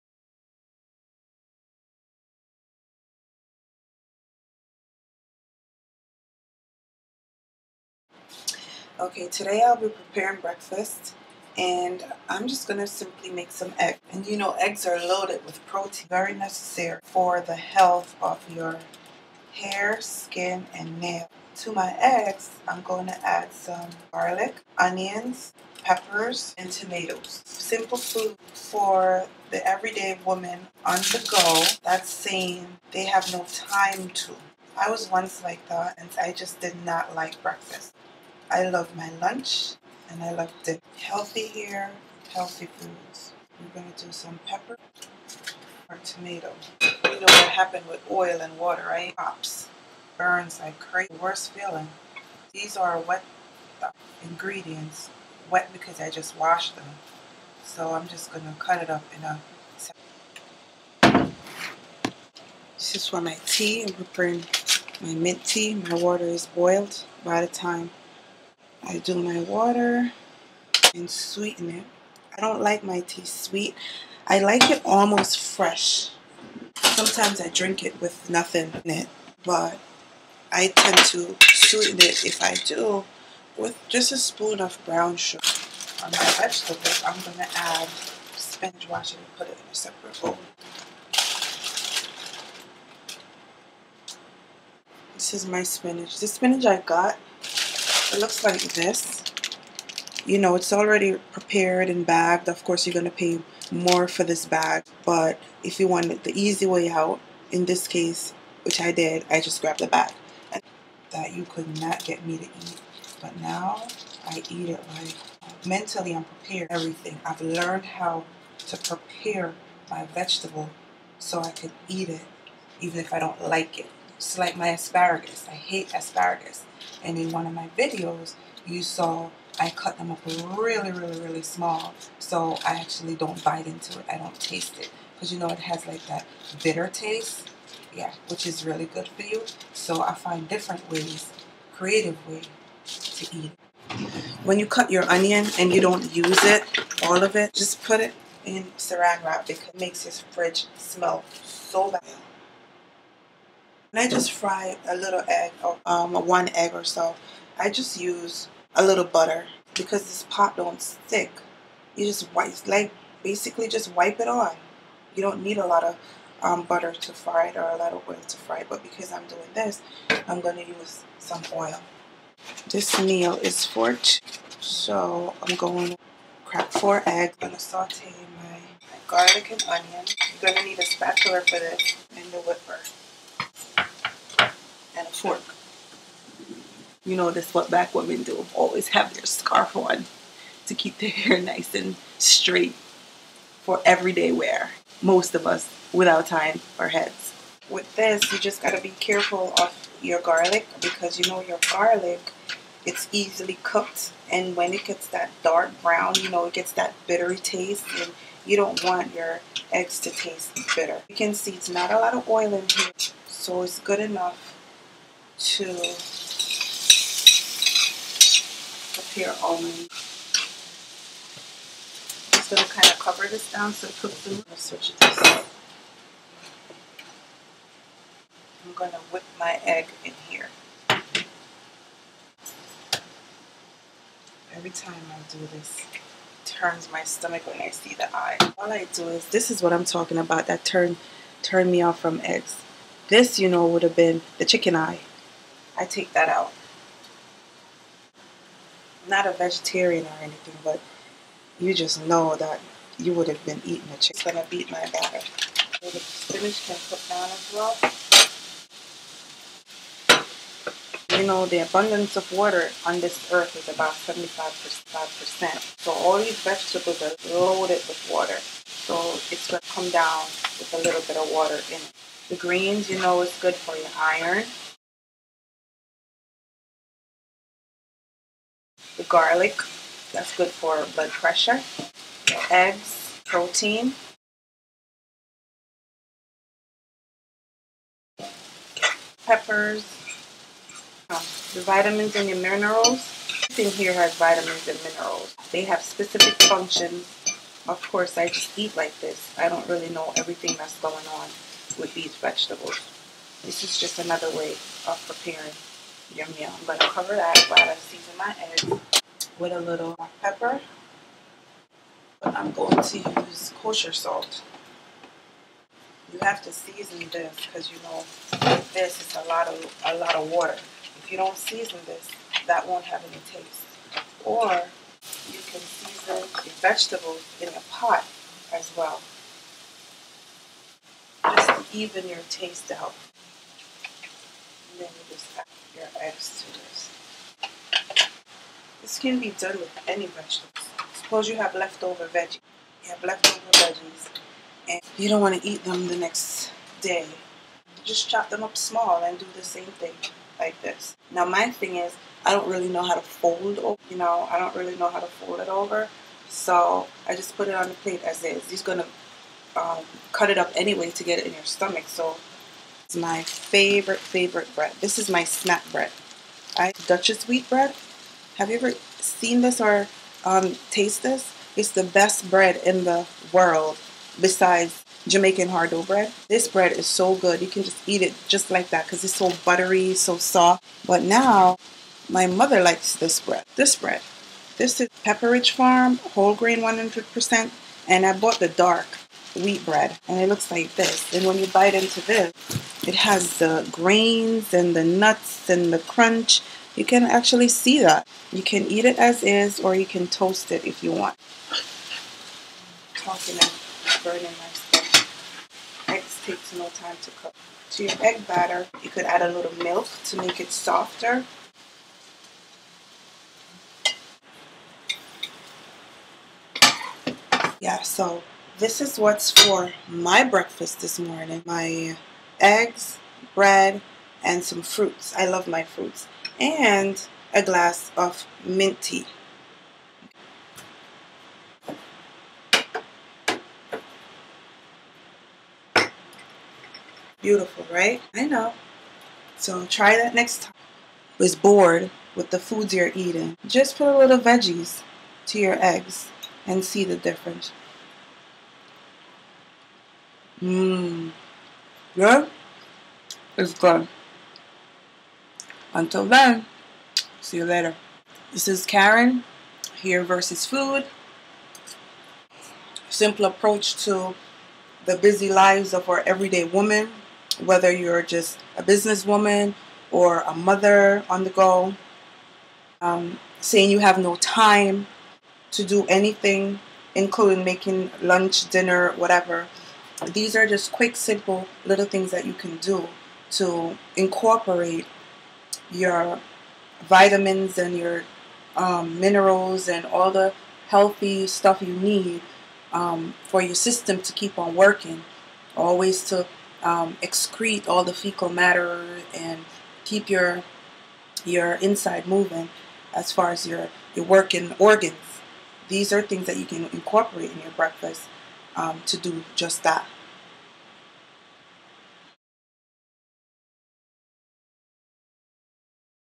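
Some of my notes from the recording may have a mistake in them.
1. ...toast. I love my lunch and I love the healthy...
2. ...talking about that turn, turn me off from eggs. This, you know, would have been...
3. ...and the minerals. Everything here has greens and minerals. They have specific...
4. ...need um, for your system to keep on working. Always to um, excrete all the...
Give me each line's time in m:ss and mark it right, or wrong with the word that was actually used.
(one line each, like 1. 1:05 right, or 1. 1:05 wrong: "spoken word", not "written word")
1. 0:37 wrong: "breakfast", not "toast"
2. 3:59 right
3. 4:52 wrong: "vitamins", not "greens"
4. 8:11 right.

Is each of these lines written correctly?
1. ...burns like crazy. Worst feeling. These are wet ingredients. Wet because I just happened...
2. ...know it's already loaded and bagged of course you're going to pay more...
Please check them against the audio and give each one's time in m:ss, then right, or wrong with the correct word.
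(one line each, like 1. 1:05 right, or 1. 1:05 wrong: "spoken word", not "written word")
1. 0:50 wrong: "washed", not "happened"
2. 1:40 wrong: "prepared", not "loaded".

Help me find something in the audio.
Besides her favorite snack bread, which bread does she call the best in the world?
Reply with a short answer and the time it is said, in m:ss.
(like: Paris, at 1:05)
Jamaican hard dough bread, at 6:15.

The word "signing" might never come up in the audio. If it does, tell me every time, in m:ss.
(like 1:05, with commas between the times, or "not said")
not said.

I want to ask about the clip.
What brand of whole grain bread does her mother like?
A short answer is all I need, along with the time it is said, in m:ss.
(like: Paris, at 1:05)
Pepperidge Farm, at 6:25.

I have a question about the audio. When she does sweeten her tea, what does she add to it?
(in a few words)
Brown sugar.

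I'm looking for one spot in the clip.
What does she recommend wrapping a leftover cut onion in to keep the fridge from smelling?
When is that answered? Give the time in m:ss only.
2:28.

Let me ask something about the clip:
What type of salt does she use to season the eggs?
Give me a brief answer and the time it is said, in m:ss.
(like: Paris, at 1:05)
Kosher salt, at 5:13.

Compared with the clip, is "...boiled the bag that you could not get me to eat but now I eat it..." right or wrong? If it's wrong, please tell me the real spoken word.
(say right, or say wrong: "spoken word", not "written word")
wrong: "grabbed", not "boiled".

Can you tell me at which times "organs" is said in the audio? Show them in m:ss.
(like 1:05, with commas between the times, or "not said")
8:24.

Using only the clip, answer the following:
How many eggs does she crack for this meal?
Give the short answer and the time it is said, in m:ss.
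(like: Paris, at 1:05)
4, at 2:56.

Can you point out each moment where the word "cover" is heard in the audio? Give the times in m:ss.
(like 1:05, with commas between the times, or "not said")
3:42, 5:06.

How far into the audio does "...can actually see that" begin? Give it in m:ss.
6:36.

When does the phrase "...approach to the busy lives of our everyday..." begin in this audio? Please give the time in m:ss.
7:43.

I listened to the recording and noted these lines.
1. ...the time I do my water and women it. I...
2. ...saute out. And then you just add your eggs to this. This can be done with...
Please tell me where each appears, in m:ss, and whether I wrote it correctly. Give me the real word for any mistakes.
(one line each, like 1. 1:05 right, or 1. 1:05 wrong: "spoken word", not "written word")
1. 1:07 wrong: "sweeten", not "women"
2. 5:32 wrong: "taste", not "saute".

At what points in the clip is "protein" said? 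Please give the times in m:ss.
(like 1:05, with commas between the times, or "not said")
0:15, 4:43.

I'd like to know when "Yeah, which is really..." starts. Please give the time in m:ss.
2:17.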